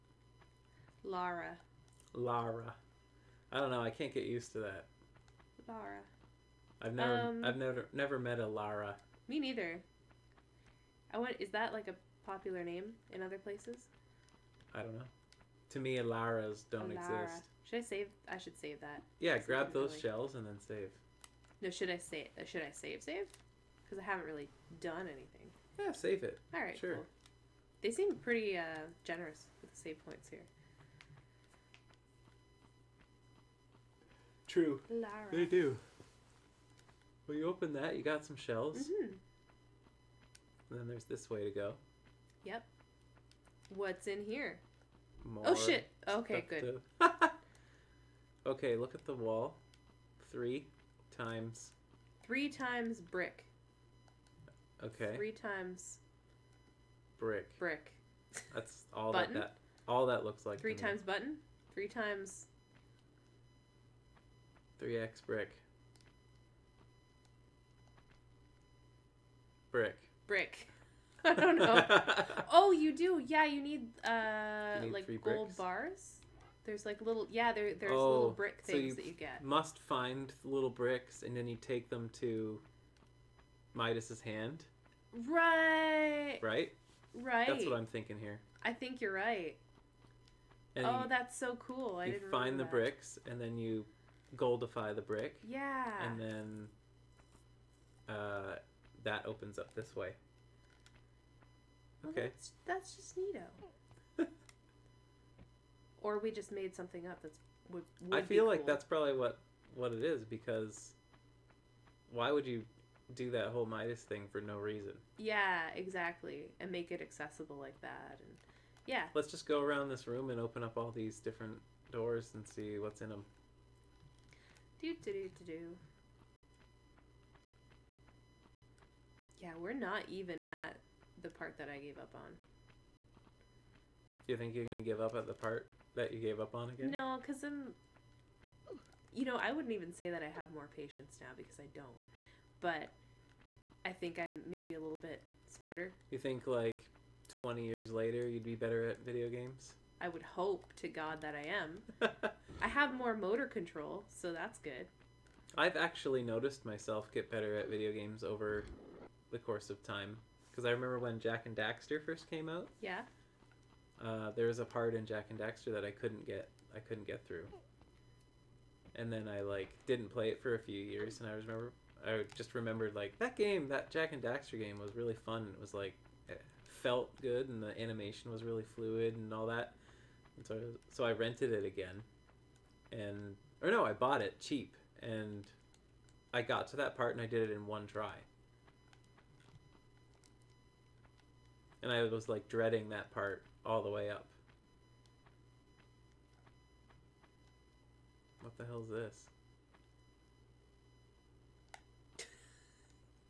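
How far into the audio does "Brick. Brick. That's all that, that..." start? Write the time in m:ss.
0:57.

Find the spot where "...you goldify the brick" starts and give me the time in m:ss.
1:33.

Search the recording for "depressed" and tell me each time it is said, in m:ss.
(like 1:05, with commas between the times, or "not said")
not said.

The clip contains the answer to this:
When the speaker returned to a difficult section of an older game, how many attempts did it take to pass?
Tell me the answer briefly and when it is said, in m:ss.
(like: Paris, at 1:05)
1 try, at 3:07.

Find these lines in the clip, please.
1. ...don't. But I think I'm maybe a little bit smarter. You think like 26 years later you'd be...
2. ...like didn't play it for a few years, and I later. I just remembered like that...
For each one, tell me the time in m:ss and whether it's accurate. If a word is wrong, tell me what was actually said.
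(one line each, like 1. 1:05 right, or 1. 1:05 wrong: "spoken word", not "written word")
1. 2:21 wrong: "20", not "26"
2. 2:49 wrong: "remember", not "later".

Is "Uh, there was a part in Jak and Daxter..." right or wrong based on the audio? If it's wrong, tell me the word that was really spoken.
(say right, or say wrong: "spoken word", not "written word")
right.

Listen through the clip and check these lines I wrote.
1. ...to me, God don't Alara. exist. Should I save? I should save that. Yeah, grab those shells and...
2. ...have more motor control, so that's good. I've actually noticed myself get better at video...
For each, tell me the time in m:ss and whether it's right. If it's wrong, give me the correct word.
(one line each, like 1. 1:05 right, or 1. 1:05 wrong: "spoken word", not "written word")
1. 0:15 wrong: "Alaras", not "God"
2. 2:32 right.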